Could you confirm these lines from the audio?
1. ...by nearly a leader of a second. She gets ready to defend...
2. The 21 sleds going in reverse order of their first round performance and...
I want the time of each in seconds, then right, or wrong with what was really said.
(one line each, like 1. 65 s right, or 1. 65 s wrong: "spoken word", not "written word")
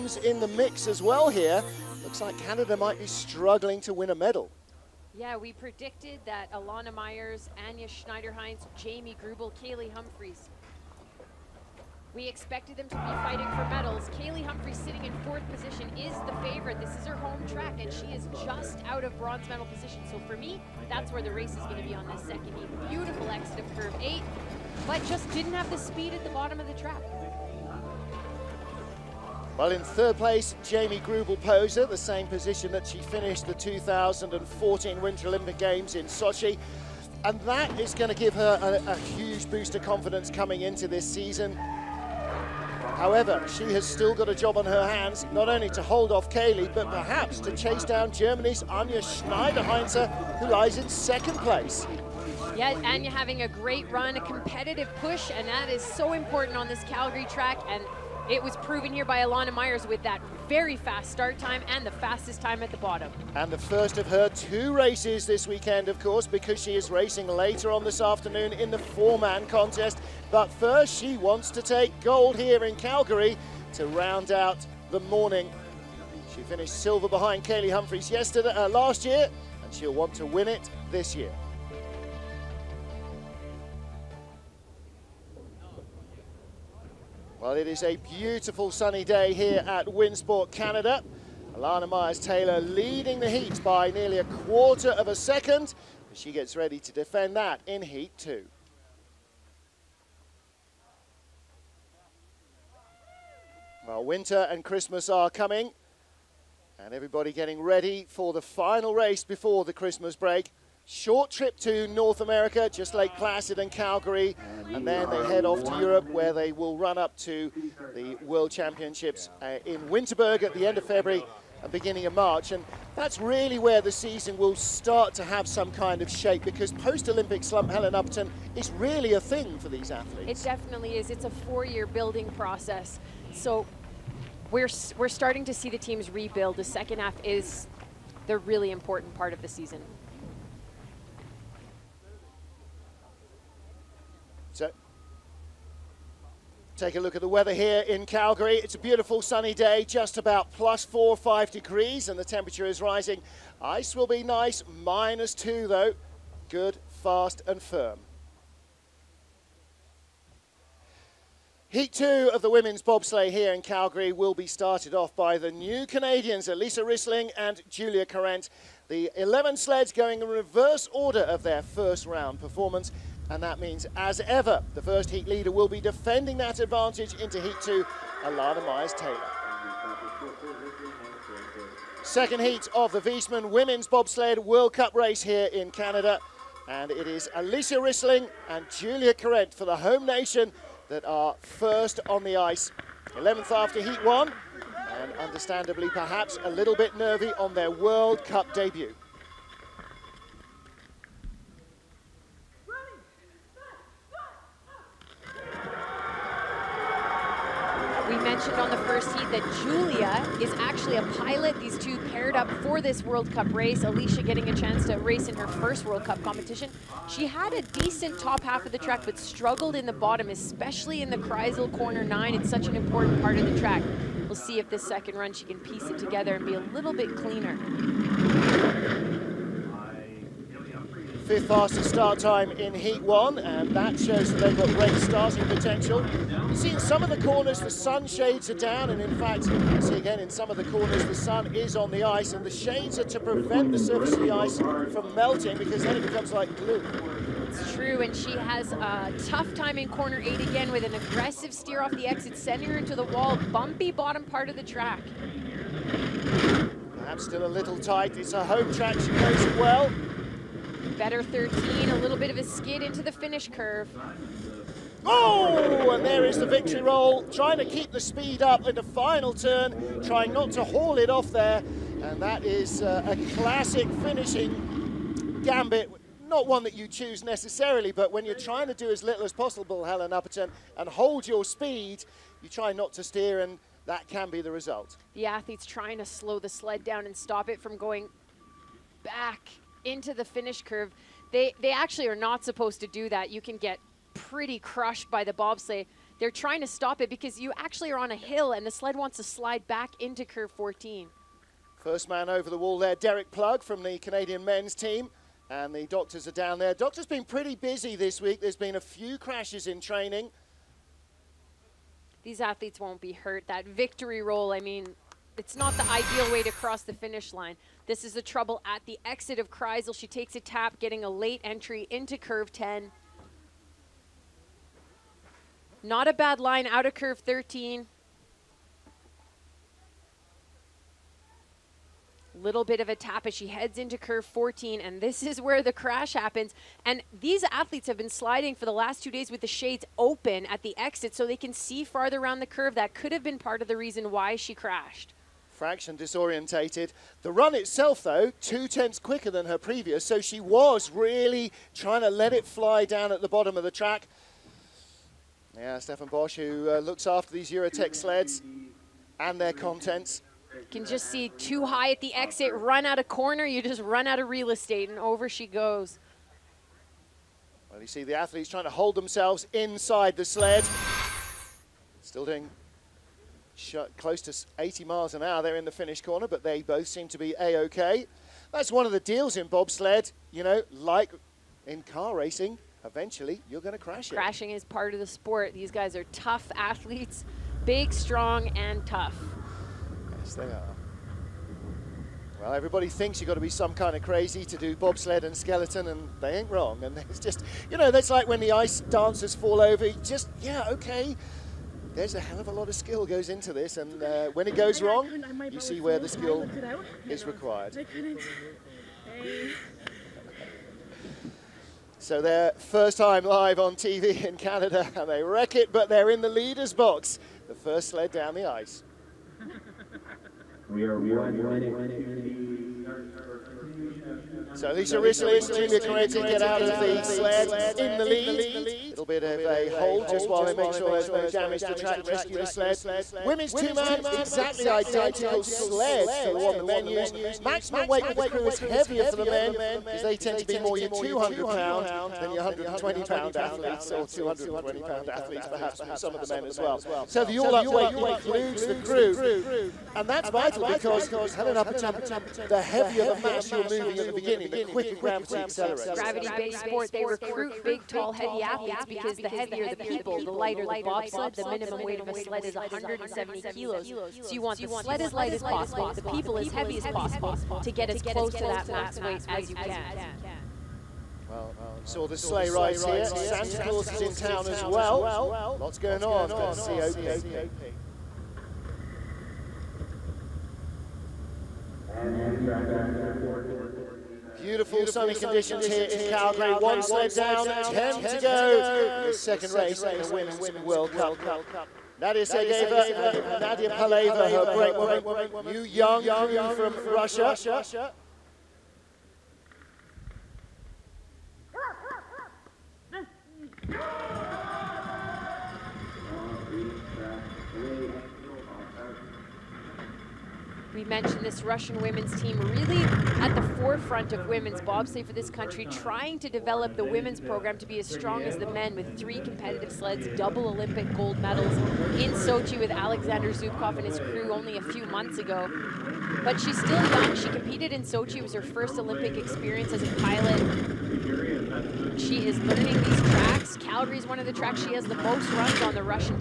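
1. 93 s wrong: "quarter", not "leader"
2. 168 s wrong: "11", not "21".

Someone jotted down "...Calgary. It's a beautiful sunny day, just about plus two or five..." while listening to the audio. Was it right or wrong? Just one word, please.
wrong.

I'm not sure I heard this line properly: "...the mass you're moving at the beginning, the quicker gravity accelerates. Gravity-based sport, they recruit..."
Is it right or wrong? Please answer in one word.
right.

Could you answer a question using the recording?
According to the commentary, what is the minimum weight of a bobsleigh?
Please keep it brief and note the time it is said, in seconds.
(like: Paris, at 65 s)
170 kilos, at 462 s.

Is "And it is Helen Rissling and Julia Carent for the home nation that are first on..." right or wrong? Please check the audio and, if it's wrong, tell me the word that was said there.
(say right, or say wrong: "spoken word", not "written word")
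wrong: "Alysia", not "Helen".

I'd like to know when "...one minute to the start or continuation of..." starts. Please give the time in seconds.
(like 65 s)
420 s.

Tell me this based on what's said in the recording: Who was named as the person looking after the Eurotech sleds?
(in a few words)
Stefan Bosch.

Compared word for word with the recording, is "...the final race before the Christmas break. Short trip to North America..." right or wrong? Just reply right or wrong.
right.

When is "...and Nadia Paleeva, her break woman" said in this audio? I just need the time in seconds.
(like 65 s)
492 s.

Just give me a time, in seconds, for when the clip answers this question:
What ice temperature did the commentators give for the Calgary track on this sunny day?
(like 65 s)
154 s.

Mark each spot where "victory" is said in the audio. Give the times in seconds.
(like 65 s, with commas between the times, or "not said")
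266 s, 313 s.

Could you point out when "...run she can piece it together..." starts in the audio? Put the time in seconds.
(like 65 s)
225 s.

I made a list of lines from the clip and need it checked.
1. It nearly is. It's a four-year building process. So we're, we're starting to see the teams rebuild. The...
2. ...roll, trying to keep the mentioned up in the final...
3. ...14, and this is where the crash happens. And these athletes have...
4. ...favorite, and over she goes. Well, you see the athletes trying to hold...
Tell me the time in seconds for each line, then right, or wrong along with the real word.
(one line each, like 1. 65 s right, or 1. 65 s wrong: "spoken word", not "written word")
1. 130 s wrong: "definitely", not "nearly"
2. 266 s wrong: "speed", not "mentioned"
3. 334 s right
4. 364 s wrong: "estate", not "favorite".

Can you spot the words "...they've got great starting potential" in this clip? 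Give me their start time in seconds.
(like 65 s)
234 s.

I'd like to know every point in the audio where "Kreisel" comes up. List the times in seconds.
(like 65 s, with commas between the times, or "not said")
221 s, 319 s.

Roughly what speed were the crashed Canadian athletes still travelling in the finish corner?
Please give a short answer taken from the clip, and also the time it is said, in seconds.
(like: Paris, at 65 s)
80 miles an hour, at 374 s.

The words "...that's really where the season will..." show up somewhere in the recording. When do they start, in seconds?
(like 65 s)
122 s.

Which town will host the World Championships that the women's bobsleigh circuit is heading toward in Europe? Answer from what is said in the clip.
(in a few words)
Winterberg.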